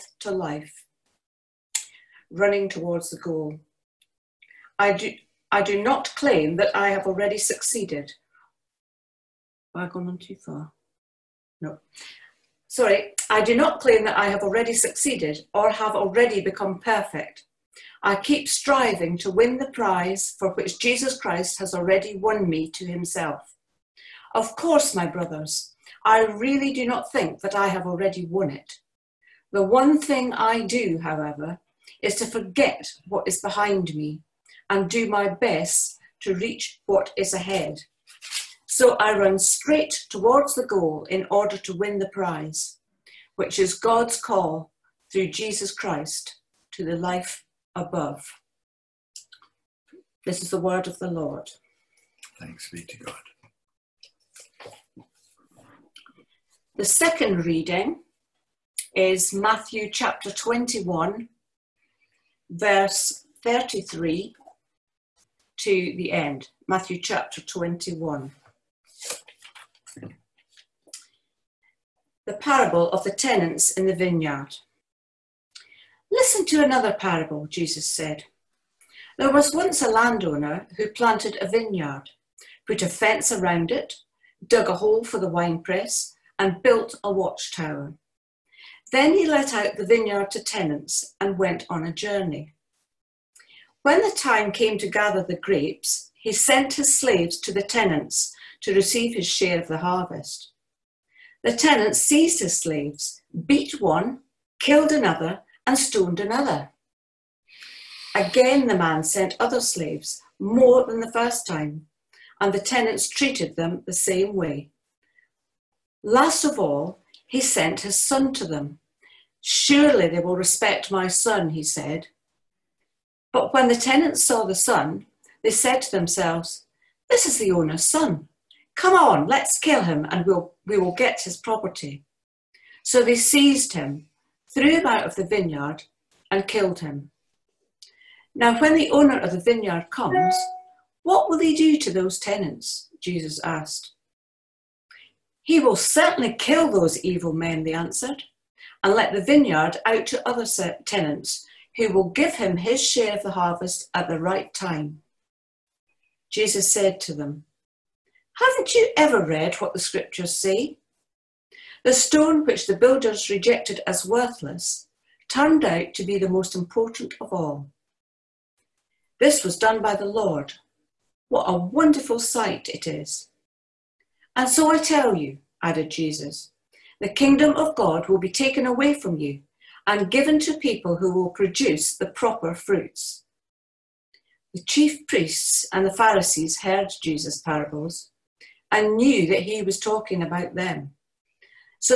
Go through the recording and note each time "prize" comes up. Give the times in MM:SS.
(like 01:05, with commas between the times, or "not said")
00:19, 00:42.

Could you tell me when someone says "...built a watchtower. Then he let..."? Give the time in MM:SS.
01:26.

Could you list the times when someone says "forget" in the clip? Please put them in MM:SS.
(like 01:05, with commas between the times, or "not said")
00:32.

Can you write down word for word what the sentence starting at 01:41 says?
The tenants seized his slaves, beat one, killed another, and stoned another.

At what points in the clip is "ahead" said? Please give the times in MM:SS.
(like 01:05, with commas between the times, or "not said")
00:37.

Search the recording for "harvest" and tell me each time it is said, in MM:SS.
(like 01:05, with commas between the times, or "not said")
01:39, 02:33.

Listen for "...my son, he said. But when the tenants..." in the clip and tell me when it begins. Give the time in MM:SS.
02:00.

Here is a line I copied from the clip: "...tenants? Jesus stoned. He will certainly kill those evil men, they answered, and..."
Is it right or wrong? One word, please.
wrong.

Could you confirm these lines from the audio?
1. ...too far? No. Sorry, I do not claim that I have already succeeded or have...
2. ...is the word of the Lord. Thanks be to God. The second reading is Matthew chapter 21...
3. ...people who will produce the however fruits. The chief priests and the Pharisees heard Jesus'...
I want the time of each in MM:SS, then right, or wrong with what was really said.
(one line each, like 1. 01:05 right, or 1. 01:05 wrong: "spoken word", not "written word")
1. 00:10 right
2. 00:50 right
3. 03:00 wrong: "proper", not "however".